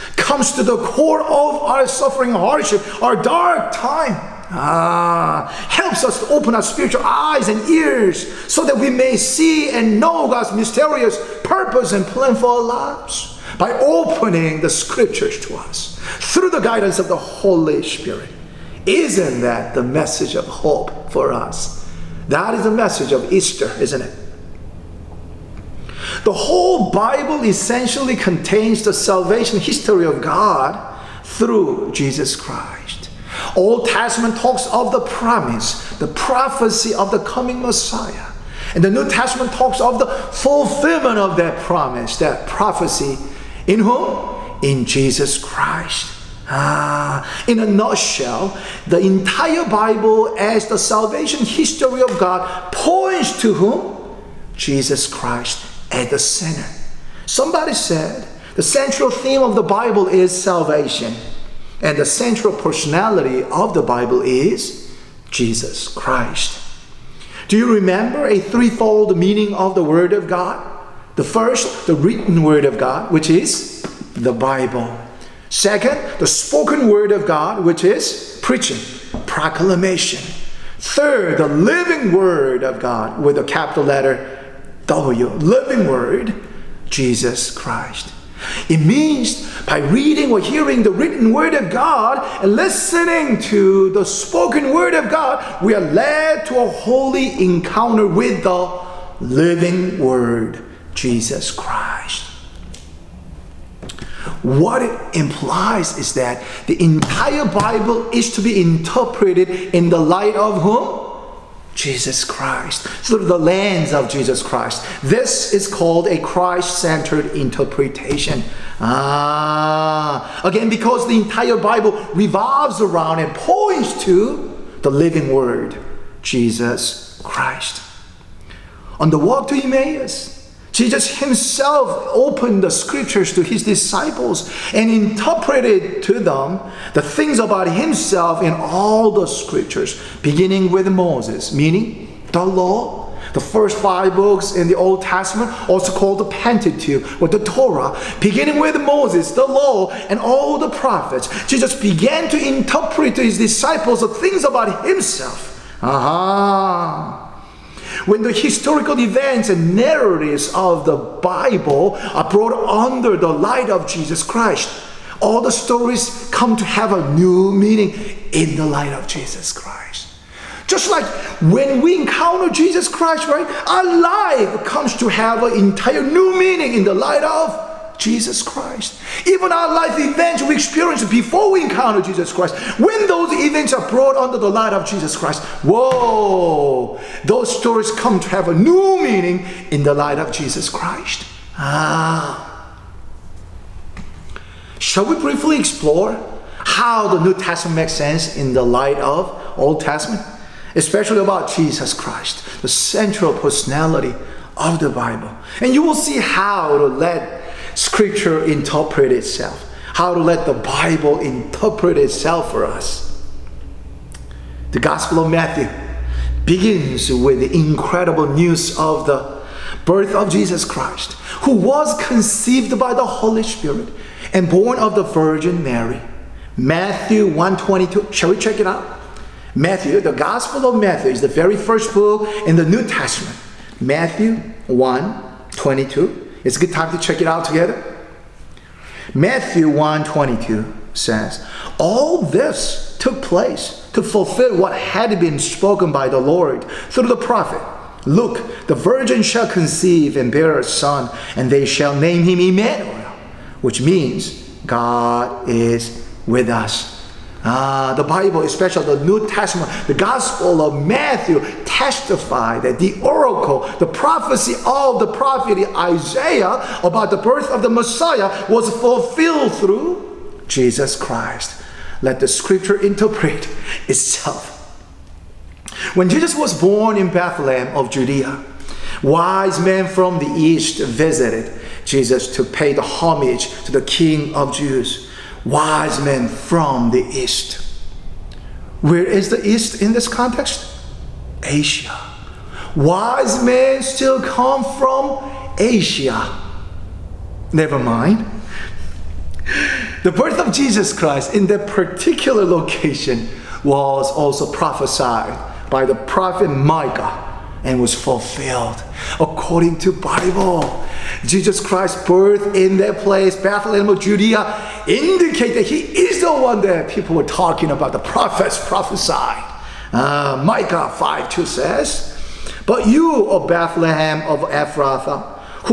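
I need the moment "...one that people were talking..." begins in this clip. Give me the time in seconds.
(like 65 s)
316 s.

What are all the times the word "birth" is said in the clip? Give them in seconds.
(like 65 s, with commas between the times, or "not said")
219 s, 267 s, 300 s, 312 s.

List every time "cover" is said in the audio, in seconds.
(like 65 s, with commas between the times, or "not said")
not said.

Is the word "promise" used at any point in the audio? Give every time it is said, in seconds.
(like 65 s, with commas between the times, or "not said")
35 s, 41 s.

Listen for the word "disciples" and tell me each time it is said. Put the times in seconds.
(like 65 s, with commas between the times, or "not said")
133 s, 153 s.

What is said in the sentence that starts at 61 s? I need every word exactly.
And the central personality of the Bible is Jesus Christ.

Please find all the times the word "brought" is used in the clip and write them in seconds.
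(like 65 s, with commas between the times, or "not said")
162 s, 183 s.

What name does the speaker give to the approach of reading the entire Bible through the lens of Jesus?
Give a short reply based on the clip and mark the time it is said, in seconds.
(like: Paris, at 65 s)
Christ centered interpretation, at 116 s.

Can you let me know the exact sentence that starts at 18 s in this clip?
Isn't that the message of hope for us?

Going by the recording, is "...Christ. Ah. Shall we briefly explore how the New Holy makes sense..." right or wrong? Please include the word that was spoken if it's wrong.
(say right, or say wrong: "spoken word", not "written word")
wrong: "Testament", not "Holy".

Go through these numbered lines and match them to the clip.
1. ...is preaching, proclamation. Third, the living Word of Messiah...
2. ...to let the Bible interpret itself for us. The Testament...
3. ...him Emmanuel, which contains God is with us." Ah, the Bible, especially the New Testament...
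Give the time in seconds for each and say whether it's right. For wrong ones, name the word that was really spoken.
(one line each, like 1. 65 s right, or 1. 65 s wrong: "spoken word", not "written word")
1. 77 s wrong: "God", not "Messiah"
2. 210 s wrong: "Gospel", not "Testament"
3. 252 s wrong: "means", not "contains".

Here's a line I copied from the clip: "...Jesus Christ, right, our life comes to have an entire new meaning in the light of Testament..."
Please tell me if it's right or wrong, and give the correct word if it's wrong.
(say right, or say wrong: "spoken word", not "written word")
wrong: "Jesus", not "Testament".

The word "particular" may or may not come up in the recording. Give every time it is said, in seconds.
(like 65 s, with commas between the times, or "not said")
301 s.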